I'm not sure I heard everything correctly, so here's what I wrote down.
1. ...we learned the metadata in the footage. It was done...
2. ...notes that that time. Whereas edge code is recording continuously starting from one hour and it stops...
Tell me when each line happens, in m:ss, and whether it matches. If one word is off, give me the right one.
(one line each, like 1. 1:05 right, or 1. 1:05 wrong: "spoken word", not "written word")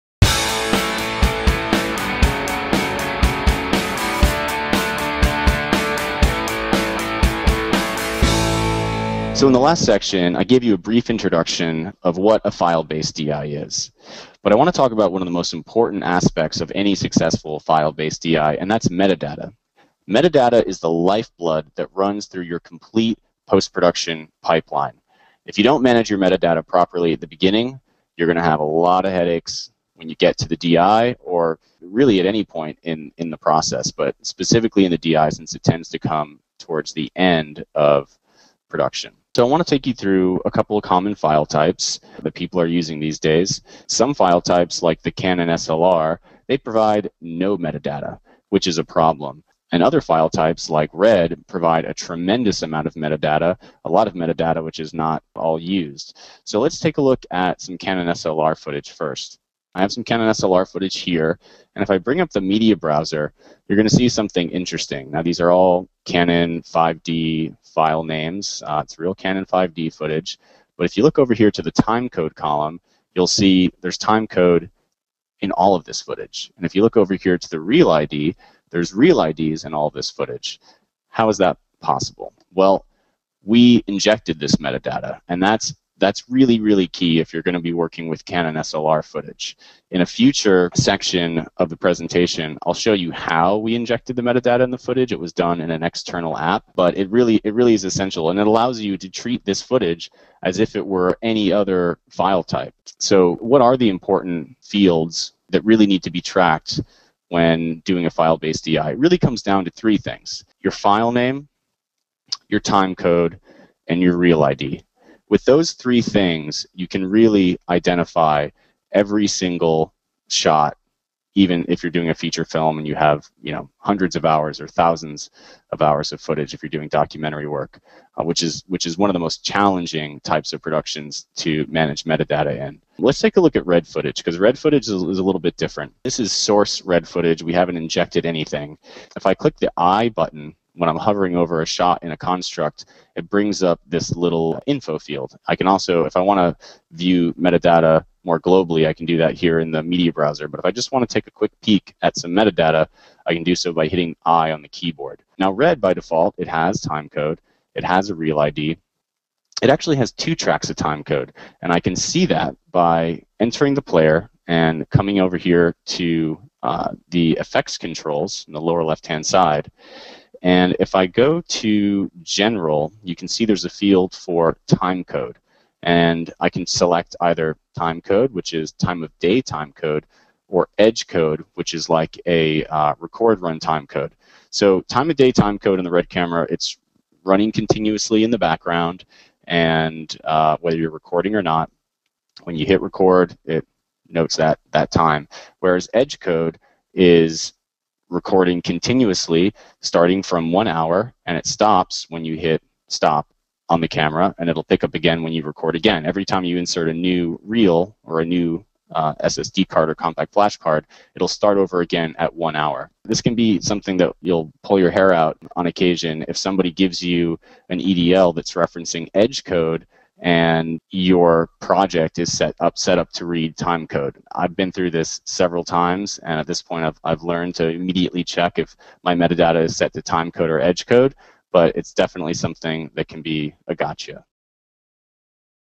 1. 1:33 wrong: "injected", not "learned"
2. 3:14 right.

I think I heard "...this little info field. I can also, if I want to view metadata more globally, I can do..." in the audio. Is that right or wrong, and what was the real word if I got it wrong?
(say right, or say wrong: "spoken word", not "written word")
right.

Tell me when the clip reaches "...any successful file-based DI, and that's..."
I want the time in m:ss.
0:16.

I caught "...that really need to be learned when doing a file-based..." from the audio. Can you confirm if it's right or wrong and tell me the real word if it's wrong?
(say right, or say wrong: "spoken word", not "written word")
wrong: "tracked", not "learned".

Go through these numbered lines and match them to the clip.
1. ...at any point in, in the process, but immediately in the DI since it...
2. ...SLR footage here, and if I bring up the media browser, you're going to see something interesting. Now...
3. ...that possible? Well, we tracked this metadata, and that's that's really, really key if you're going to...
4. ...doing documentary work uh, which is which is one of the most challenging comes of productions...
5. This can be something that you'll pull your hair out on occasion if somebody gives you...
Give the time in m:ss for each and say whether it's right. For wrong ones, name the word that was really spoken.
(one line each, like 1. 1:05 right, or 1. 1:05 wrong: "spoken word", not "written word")
1. 0:32 wrong: "specifically", not "immediately"
2. 1:00 right
3. 1:21 wrong: "injected", not "tracked"
4. 2:06 wrong: "types", not "comes"
5. 3:33 right.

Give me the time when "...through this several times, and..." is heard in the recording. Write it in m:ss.
3:44.